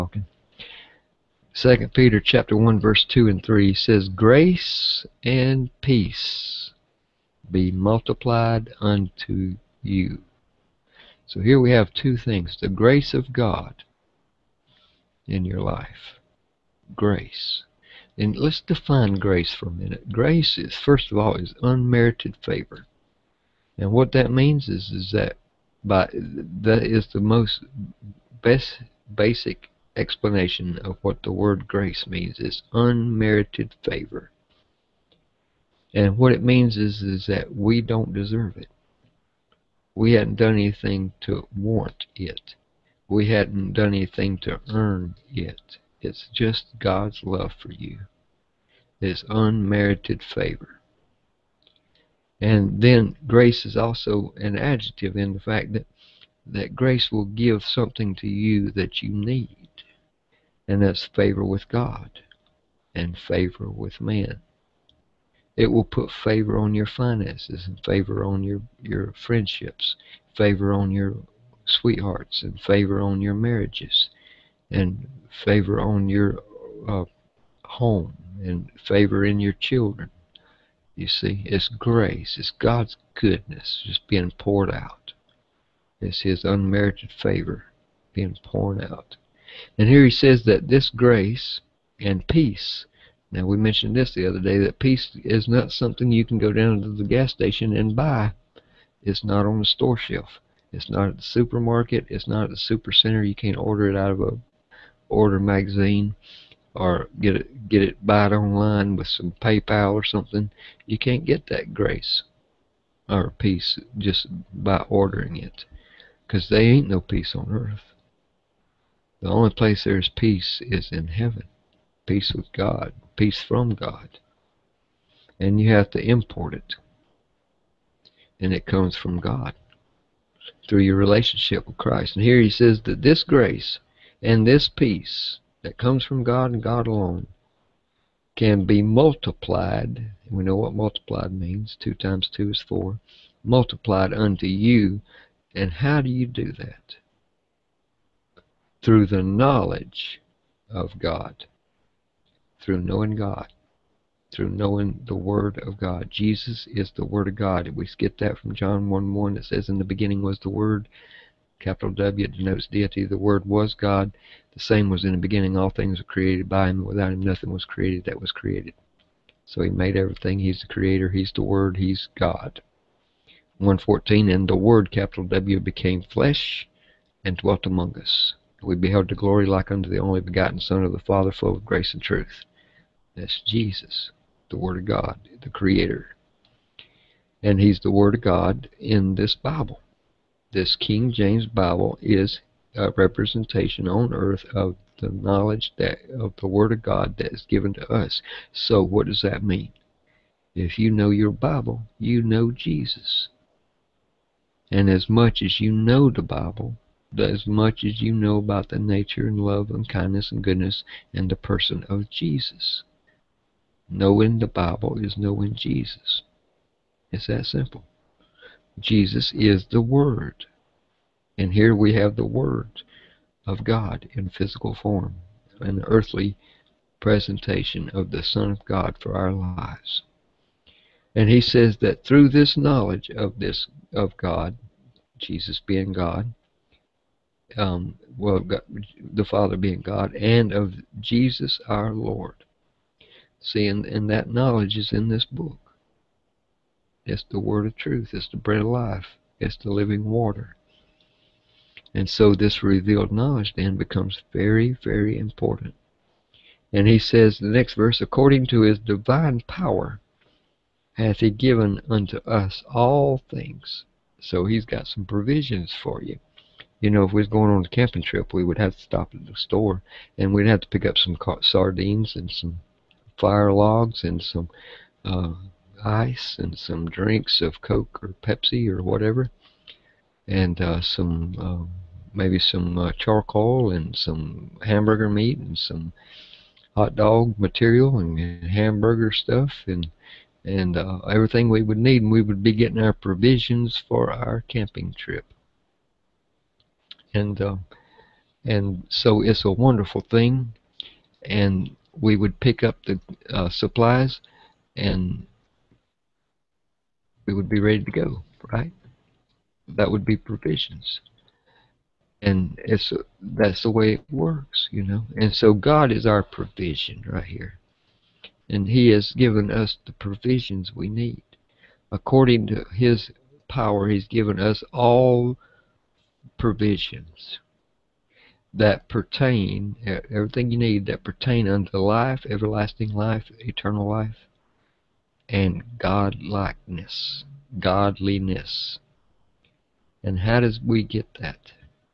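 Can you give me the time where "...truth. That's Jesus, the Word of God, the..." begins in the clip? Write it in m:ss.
3:02.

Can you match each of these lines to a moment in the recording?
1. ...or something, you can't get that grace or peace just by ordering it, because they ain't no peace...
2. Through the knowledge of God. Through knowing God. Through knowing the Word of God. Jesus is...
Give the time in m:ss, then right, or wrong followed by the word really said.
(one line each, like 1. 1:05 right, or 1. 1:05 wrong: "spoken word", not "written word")
1. 1:49 right
2. 2:28 right.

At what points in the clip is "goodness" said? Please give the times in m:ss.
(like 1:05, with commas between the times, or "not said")
1:23, 3:30.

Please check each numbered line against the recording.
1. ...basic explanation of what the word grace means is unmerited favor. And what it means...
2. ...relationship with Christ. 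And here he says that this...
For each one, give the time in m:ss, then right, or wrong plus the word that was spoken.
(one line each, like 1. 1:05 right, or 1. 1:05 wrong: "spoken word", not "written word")
1. 0:29 right
2. 2:10 right.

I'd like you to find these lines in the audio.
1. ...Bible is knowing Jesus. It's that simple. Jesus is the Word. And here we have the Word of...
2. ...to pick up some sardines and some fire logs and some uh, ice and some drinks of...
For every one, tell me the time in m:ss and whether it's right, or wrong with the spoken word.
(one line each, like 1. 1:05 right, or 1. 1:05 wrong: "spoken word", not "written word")
1. 3:34 right
2. 4:30 right.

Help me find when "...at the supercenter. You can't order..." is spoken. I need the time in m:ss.
1:42.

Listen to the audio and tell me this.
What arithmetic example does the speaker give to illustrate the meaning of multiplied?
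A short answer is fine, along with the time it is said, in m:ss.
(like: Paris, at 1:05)
Two times two is four, at 2:21.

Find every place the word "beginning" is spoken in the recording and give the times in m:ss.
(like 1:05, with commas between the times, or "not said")
2:39, 2:45.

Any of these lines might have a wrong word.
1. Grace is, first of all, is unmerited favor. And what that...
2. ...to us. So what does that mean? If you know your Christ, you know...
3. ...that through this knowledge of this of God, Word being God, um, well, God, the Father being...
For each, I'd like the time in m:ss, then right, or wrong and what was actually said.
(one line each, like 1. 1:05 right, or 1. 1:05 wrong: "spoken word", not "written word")
1. 0:20 right
2. 3:17 wrong: "Bible", not "Christ"
3. 3:51 wrong: "Jesus", not "Word".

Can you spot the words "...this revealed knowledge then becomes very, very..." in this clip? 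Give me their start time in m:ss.
4:12.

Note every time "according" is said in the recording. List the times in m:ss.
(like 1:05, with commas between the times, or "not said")
4:18, 5:21.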